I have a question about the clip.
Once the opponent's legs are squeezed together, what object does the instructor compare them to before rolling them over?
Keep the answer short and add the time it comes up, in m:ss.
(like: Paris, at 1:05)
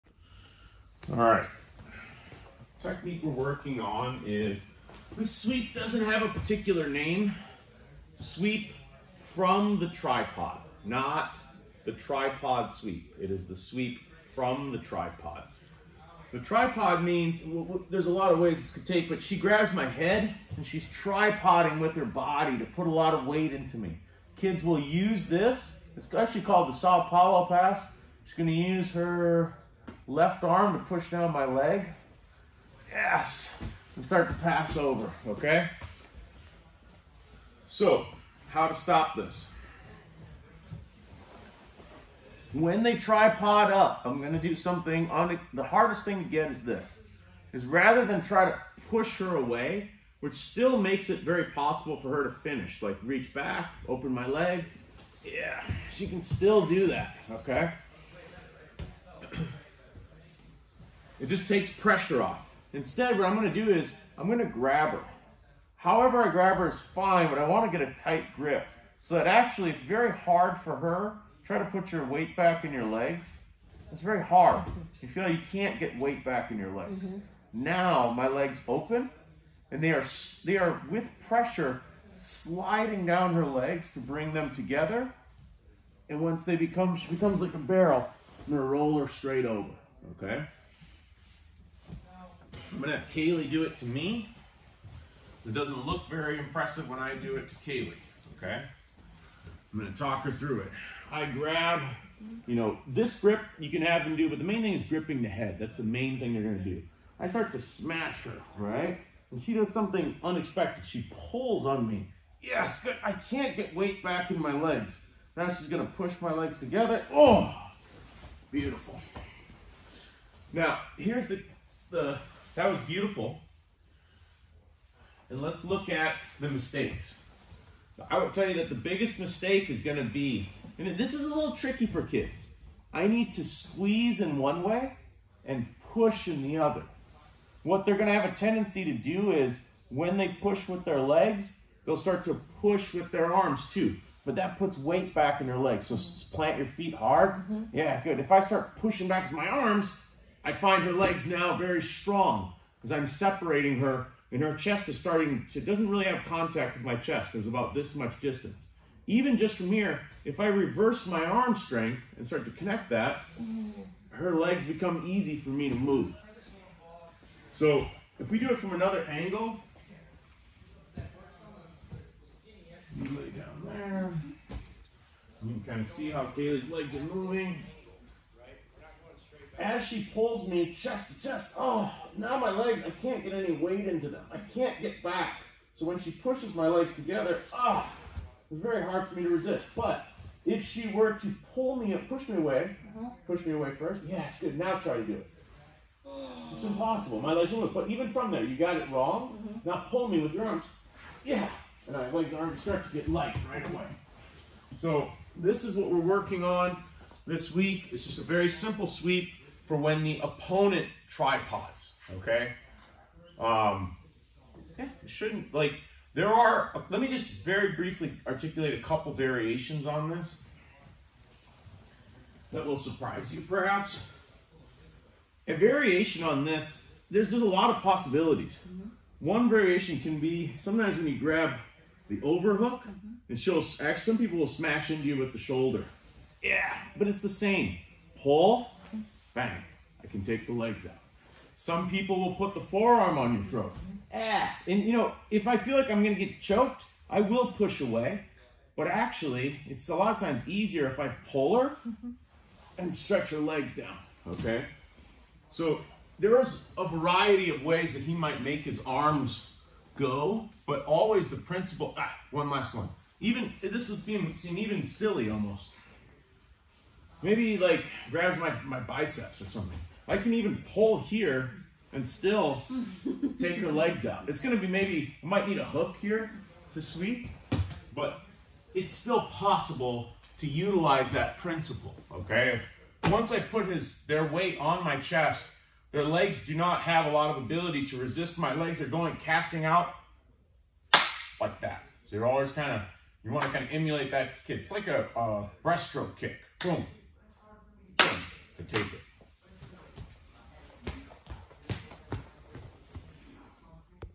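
A barrel, at 1:27.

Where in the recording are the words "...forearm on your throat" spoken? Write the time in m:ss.
4:02.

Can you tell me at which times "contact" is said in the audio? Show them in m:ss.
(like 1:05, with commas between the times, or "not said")
2:36.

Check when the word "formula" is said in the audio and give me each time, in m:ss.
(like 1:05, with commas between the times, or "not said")
not said.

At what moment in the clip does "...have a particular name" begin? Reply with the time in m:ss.
0:06.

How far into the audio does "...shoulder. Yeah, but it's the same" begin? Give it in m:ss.
3:55.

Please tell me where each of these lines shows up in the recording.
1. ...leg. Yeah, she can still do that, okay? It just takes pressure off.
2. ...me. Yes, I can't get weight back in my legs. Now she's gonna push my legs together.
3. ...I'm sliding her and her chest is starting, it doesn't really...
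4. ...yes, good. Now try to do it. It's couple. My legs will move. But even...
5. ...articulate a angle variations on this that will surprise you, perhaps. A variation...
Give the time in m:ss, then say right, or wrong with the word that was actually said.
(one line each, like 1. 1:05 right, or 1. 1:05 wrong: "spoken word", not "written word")
1. 0:54 right
2. 1:51 right
3. 2:32 wrong: "separating", not "sliding"
4. 3:14 wrong: "impossible", not "couple"
5. 3:38 wrong: "couple", not "angle".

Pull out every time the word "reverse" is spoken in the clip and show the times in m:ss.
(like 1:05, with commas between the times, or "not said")
2:40.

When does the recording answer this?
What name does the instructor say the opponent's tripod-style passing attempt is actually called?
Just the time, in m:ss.
0:26.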